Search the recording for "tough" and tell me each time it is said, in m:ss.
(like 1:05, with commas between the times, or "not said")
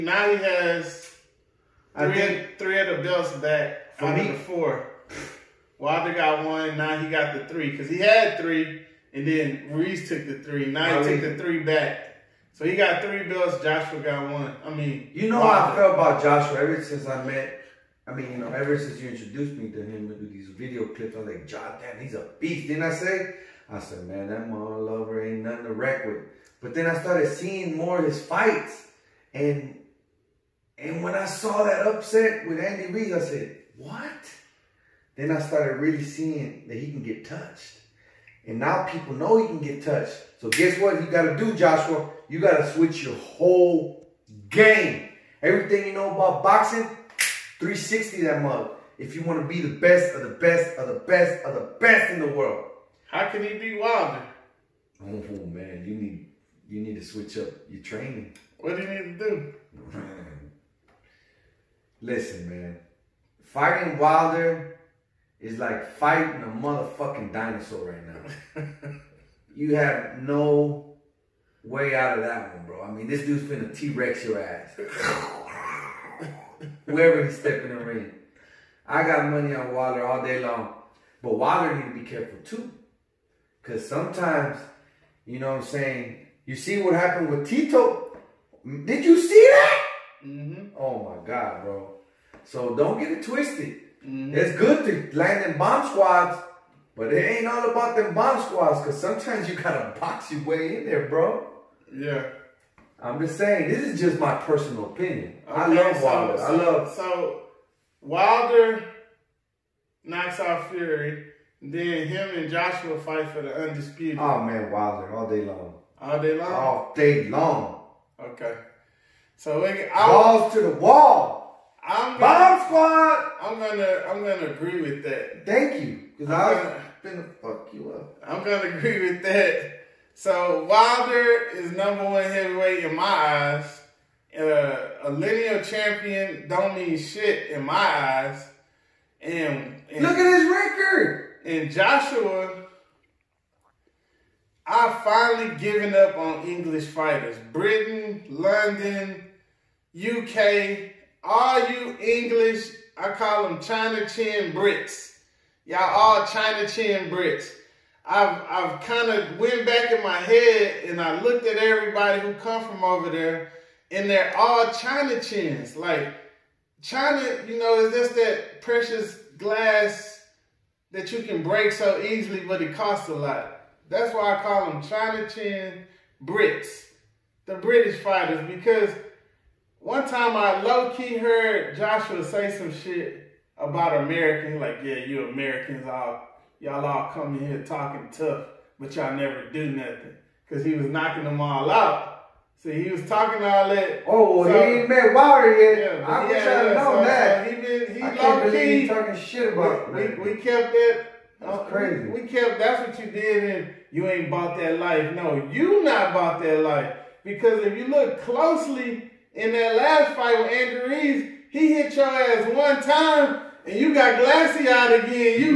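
3:08.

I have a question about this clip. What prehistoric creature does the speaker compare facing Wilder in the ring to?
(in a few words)
Dinosaur.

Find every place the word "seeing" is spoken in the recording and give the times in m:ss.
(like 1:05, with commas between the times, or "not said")
0:27, 0:36.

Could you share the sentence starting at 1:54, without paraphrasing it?
Oh, man, Wilder, all day long.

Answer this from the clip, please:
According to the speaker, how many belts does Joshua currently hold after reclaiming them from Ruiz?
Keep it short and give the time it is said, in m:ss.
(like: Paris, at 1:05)
3, at 0:12.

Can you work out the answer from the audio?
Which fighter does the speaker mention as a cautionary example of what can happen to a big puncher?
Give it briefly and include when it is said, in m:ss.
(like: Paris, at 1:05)
Tito, at 1:27.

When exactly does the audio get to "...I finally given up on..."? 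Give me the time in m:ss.
2:24.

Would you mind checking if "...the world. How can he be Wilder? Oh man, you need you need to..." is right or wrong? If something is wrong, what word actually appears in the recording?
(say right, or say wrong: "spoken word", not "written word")
right.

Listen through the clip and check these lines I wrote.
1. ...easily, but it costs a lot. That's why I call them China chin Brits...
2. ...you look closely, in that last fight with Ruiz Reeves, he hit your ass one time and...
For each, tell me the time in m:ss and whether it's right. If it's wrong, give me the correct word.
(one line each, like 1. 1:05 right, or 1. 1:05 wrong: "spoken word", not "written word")
1. 2:52 right
2. 3:27 wrong: "Andrew", not "Ruiz".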